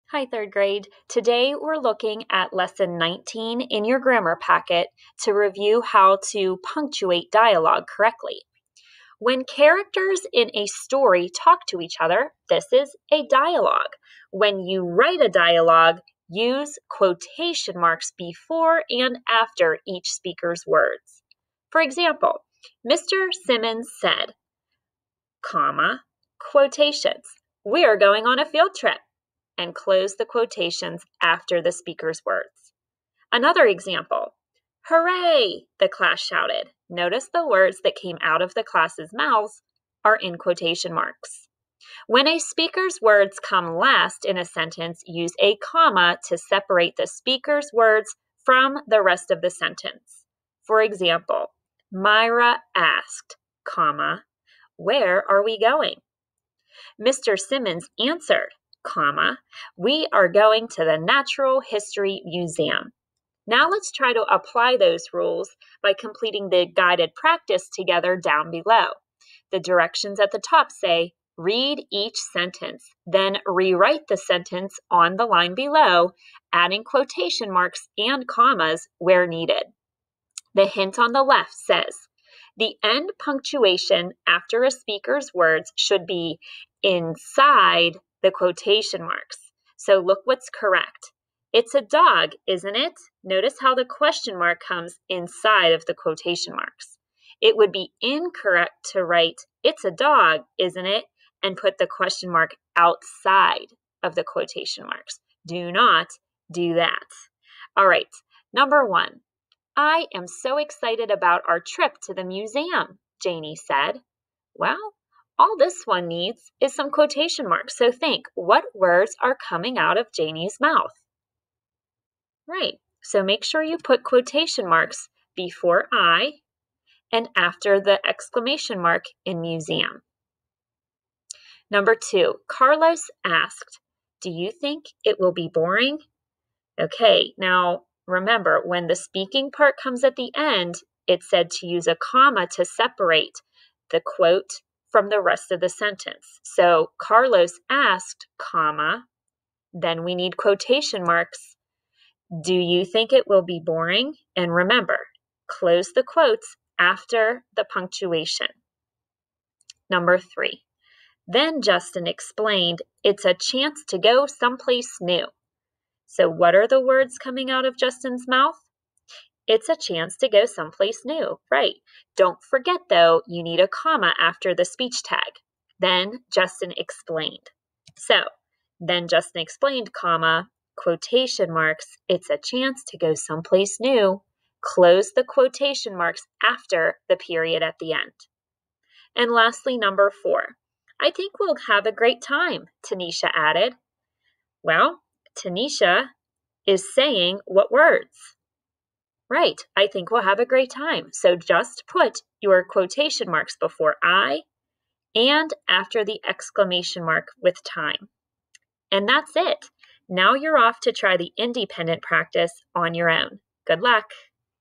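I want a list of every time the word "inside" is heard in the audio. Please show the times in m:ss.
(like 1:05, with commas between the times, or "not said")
1:26, 1:35.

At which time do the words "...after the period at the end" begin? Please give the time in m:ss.
3:06.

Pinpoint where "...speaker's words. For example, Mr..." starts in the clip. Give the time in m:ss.
0:20.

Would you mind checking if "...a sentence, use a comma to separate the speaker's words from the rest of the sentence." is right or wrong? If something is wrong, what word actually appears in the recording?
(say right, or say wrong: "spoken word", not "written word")
right.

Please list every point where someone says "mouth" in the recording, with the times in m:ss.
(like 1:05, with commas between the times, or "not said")
0:39, 2:00, 2:48.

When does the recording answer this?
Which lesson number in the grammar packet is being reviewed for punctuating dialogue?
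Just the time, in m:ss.
0:02.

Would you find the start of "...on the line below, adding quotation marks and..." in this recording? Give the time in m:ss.
1:14.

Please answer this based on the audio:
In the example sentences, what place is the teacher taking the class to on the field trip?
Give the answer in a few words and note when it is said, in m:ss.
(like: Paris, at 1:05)
Natural History Museum, at 1:00.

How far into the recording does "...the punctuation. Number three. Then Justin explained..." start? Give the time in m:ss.
2:37.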